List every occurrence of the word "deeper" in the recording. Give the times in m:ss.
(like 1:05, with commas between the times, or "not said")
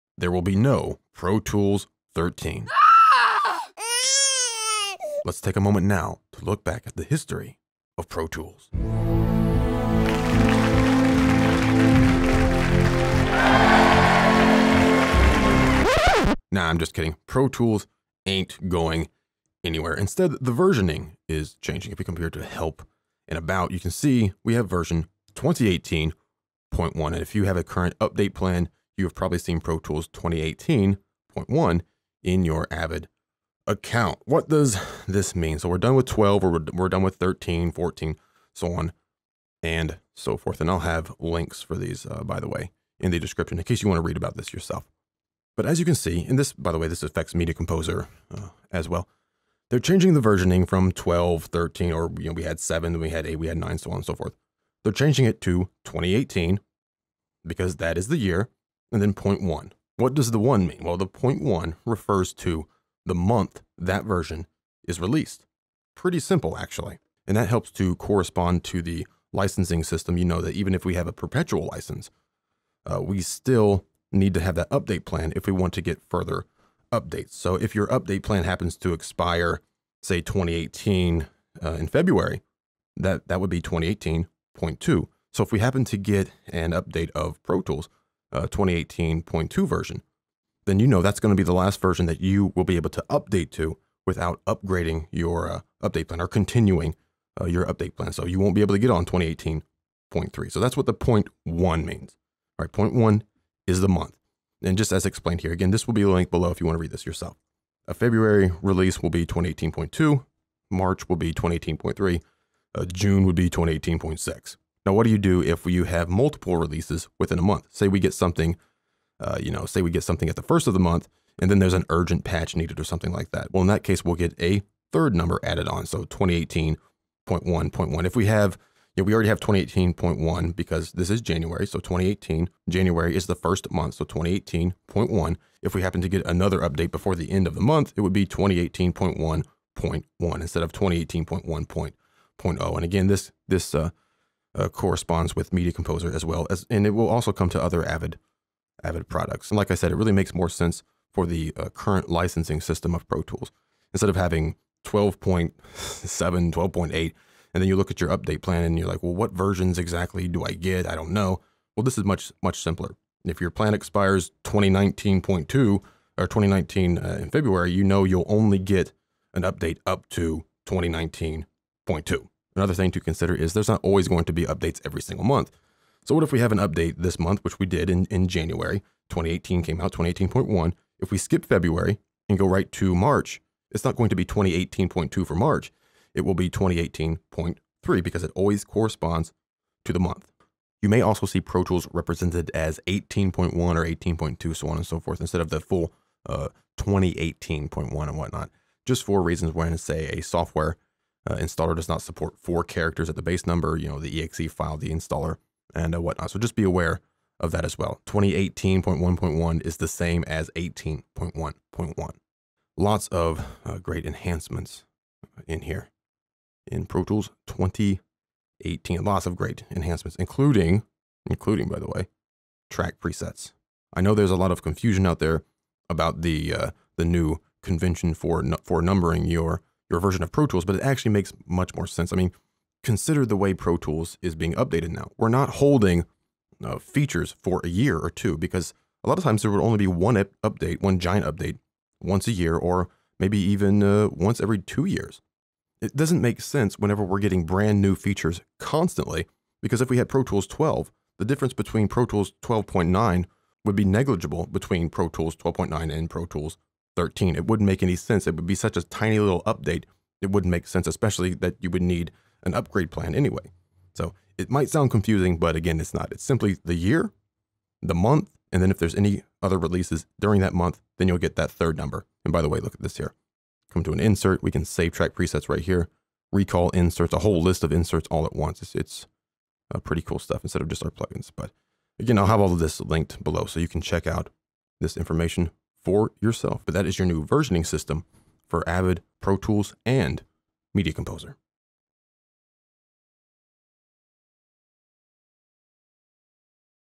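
not said.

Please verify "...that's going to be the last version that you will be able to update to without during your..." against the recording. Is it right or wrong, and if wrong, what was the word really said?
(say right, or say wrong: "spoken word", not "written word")
wrong: "upgrading", not "during".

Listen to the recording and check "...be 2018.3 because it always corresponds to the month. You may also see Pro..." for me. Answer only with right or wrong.
right.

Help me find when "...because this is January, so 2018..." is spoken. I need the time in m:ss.
2:10.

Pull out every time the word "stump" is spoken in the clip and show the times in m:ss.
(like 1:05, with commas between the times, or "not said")
not said.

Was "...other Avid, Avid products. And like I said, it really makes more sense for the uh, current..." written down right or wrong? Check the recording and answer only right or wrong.
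right.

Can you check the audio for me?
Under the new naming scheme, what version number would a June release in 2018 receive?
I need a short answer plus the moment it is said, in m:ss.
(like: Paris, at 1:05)
2018.6, at 1:53.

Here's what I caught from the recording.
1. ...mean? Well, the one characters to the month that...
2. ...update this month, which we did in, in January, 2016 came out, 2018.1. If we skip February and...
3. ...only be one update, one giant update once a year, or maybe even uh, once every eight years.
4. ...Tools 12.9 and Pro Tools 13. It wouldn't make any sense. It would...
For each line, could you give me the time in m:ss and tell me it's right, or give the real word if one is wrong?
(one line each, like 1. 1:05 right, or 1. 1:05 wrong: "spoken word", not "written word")
1. 1:00 wrong: "refers", not "characters"
2. 2:56 wrong: "2018", not "2016"
3. 3:59 wrong: "two", not "eight"
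4. 4:15 right.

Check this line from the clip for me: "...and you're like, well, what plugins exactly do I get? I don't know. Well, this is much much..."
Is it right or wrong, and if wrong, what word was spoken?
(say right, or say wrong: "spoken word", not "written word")
wrong: "versions", not "plugins".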